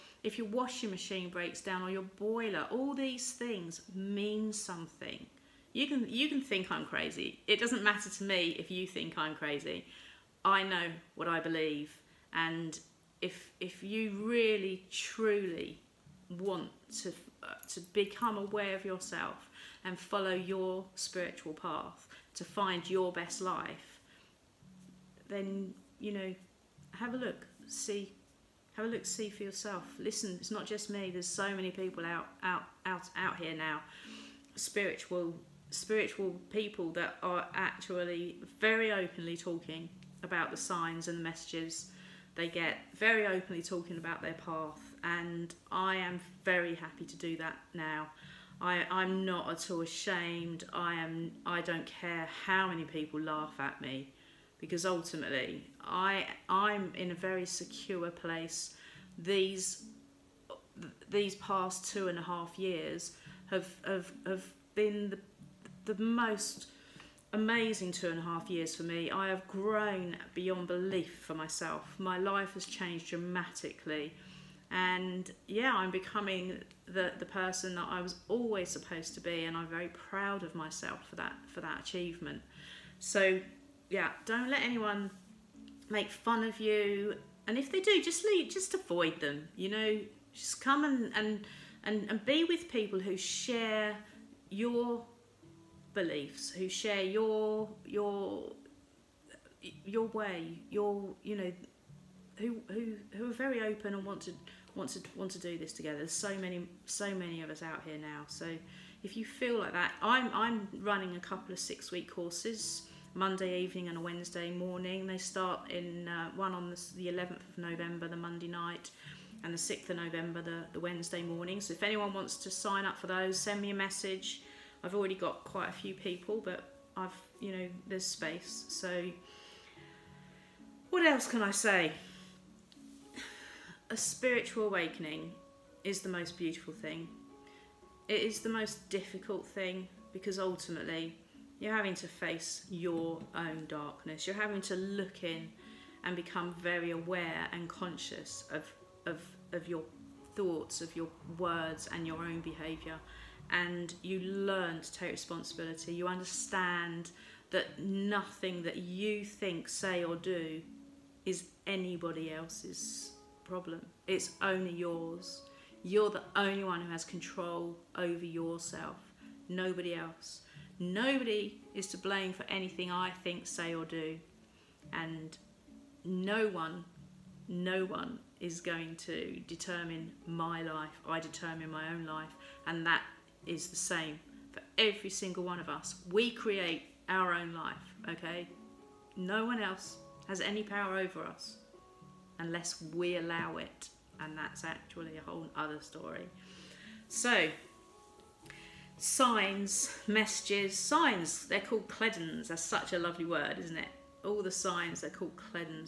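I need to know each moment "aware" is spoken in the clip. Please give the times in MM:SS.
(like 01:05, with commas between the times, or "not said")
00:18, 02:26.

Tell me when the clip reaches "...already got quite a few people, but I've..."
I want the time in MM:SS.
02:04.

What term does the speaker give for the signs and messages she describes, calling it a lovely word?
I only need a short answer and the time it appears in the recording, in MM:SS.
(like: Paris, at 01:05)
cledons, at 03:21.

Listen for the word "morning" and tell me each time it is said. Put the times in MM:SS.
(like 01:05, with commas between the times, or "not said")
01:54, 02:01.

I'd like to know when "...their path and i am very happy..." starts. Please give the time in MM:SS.
00:44.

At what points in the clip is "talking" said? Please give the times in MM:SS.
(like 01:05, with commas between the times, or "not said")
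00:39, 00:43.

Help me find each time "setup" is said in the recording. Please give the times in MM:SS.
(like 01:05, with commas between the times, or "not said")
not said.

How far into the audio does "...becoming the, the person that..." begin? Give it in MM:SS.
01:15.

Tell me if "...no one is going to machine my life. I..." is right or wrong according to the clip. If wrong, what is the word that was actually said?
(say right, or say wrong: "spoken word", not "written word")
wrong: "determine", not "machine".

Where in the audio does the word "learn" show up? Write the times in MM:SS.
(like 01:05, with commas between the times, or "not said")
02:34.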